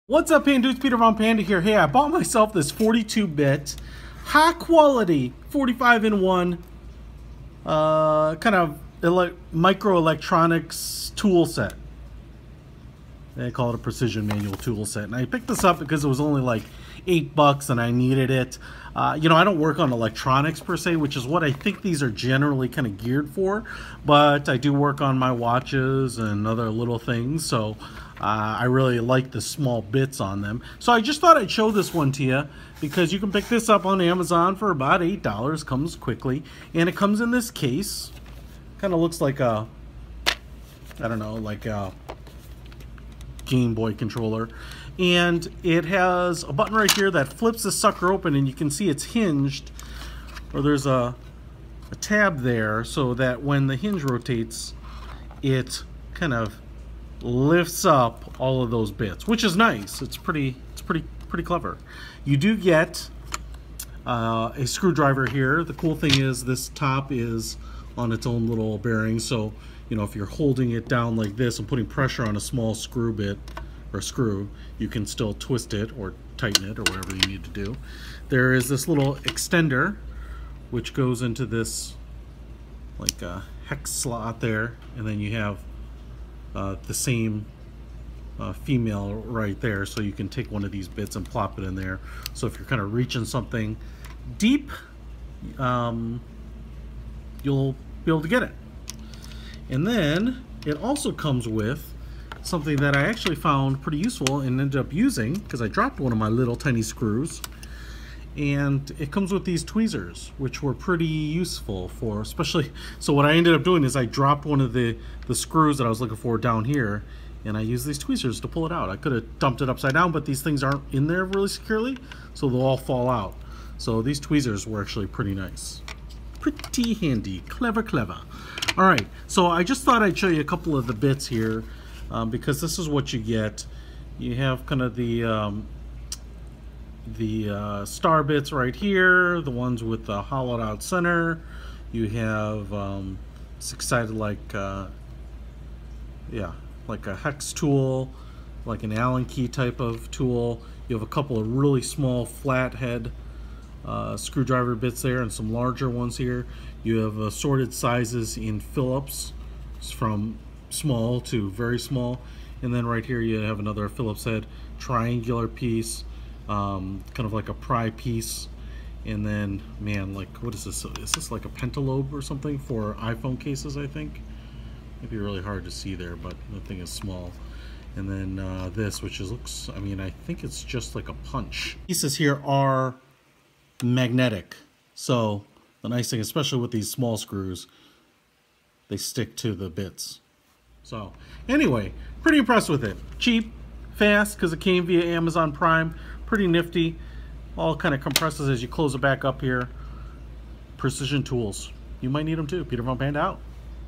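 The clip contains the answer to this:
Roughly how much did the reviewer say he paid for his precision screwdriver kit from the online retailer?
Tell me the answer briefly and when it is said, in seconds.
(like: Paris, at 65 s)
$8, at 17 s.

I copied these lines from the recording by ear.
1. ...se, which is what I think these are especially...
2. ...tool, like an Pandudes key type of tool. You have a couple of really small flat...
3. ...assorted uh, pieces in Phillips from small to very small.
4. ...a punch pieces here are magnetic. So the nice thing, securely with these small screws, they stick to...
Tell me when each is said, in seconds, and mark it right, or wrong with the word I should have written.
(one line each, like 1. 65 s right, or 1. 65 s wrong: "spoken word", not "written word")
1. 20 s wrong: "generally", not "especially"
2. 147 s wrong: "Allen", not "Pandudes"
3. 157 s wrong: "sizes", not "pieces"
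4. 181 s wrong: "especially", not "securely".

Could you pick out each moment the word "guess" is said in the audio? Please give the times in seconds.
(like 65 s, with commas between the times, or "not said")
not said.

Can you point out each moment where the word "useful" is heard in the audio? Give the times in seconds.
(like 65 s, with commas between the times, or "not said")
103 s, 111 s.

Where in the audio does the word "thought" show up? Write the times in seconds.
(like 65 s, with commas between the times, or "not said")
31 s, 129 s.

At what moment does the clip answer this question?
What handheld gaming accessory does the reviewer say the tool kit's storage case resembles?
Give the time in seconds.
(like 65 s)
43 s.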